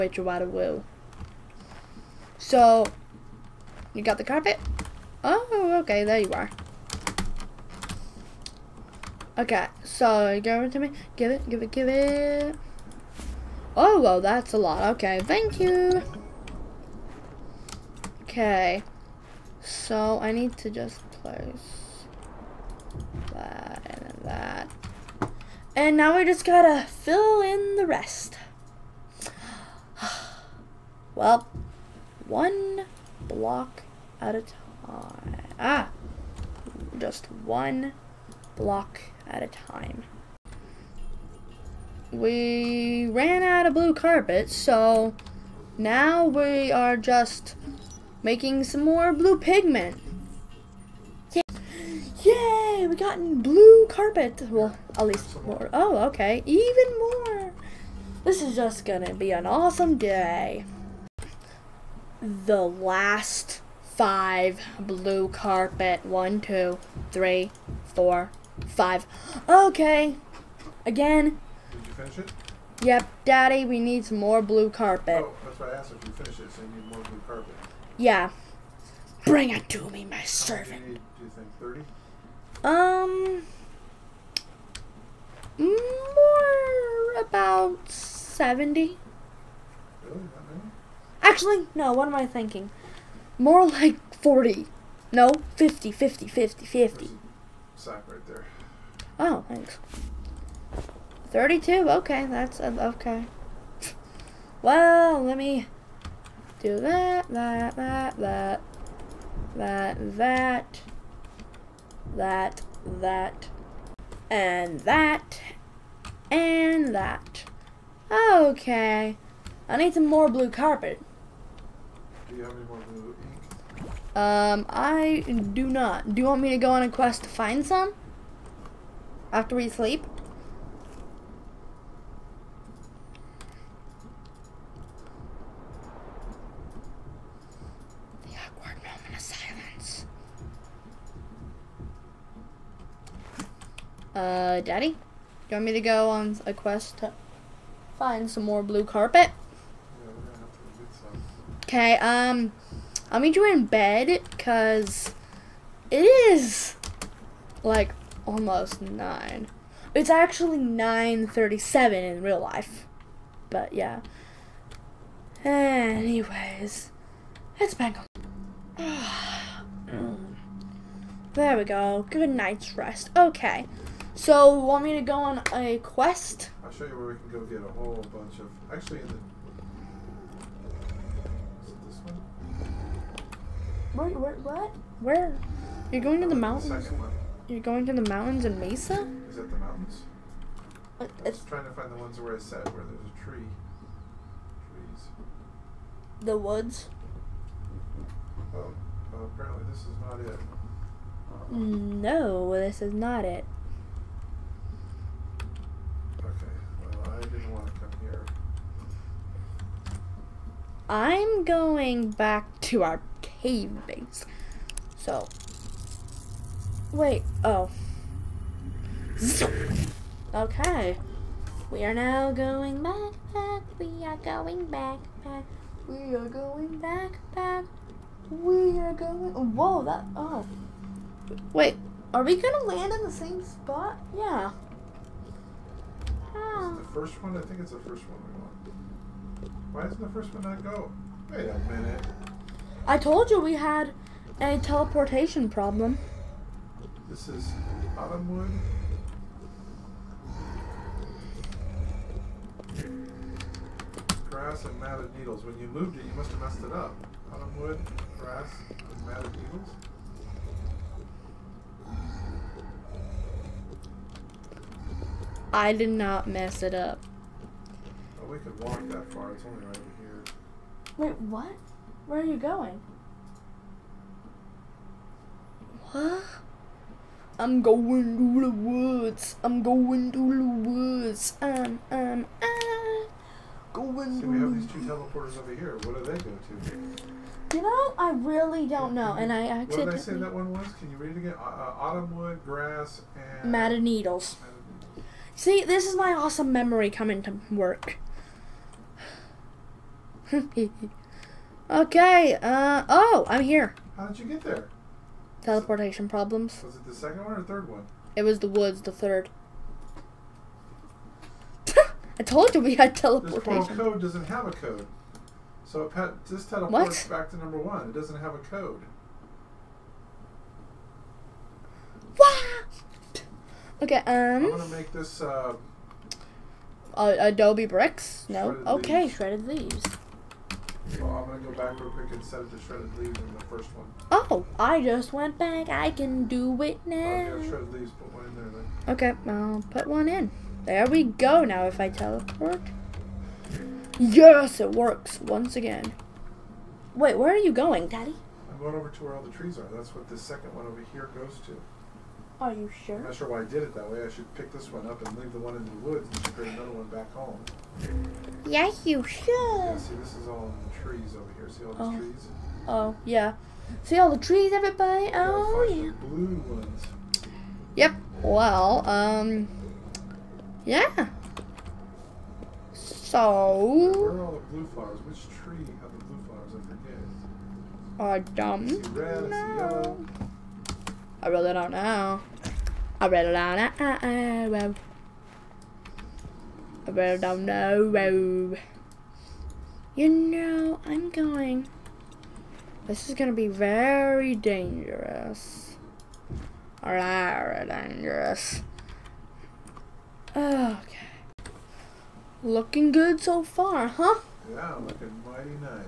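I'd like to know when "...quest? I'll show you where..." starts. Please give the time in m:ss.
2:55.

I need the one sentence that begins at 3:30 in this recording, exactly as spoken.
I'm going back to our caves.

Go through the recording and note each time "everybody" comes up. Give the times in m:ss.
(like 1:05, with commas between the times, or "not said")
6:04.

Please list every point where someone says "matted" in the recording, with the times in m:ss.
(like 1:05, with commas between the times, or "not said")
4:14, 4:19, 4:53.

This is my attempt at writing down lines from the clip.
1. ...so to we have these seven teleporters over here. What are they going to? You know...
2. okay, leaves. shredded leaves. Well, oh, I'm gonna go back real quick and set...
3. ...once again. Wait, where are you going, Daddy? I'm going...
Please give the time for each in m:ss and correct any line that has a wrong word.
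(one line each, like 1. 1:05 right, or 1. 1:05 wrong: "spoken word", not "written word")
1. 4:44 wrong: "two", not "seven"
2. 5:28 right
3. 5:45 right.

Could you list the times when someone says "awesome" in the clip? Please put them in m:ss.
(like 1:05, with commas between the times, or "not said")
0:59, 4:56.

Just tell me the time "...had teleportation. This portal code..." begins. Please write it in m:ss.
5:12.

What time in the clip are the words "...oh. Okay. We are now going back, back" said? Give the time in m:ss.
3:37.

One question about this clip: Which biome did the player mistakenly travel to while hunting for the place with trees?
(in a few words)
Mesa.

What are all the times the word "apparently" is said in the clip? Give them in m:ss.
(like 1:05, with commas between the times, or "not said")
3:19.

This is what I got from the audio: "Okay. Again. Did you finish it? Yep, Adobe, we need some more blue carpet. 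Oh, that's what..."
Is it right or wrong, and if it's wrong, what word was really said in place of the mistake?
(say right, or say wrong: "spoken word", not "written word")
wrong: "Daddy", not "Adobe".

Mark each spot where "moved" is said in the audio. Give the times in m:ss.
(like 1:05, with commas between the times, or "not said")
4:15.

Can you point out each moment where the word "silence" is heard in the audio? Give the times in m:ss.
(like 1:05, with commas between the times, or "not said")
2:19.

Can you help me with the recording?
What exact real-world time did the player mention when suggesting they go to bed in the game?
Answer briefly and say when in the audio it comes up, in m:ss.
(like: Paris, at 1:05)
9:37, at 2:40.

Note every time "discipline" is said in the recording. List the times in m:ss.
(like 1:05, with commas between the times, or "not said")
not said.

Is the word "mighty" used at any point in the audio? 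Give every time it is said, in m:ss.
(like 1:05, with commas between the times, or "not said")
6:45.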